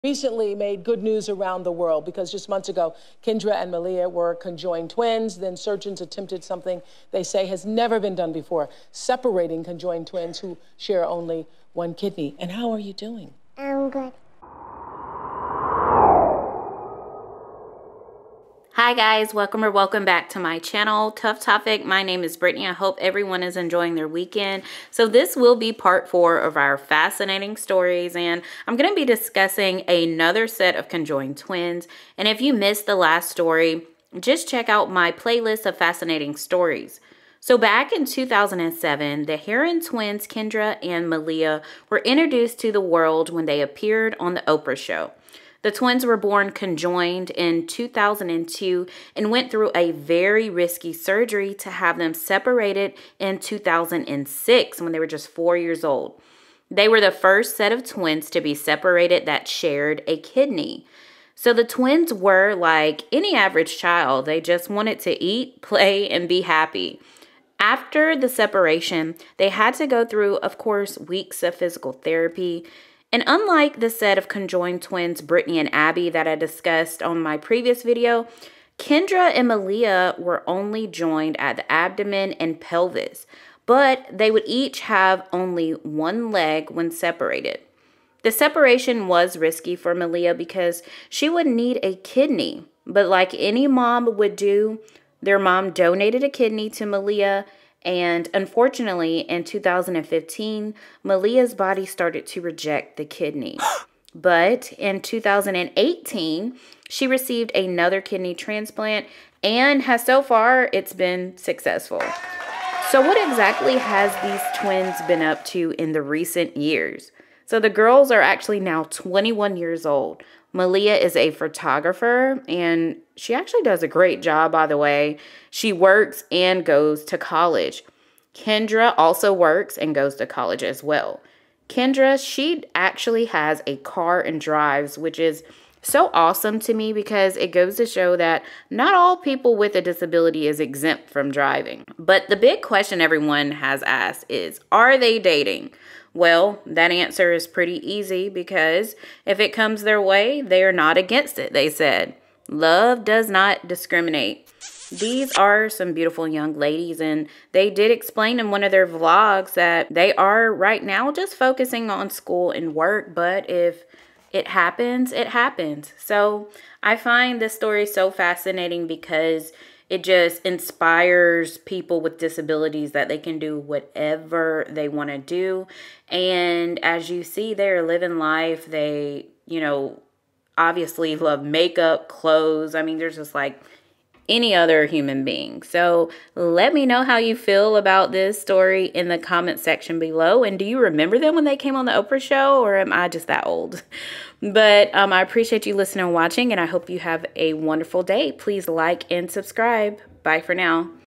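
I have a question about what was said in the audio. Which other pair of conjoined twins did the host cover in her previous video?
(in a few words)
Brittany and Abby.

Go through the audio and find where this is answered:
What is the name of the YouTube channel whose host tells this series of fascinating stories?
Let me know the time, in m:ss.
0:21.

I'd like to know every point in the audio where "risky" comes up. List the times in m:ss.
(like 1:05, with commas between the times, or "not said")
0:50, 1:29.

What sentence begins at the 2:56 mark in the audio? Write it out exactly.
And as you see, they're living life.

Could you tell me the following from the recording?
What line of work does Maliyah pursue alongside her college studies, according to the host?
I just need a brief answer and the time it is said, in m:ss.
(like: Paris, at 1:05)
Photographer, at 2:01.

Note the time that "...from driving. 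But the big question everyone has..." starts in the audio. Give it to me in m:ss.
2:21.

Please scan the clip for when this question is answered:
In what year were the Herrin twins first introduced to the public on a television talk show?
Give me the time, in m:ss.
0:38.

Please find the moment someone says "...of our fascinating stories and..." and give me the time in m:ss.
0:26.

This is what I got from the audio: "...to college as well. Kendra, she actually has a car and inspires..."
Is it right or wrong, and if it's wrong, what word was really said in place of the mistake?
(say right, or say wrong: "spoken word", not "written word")
wrong: "drives", not "inspires".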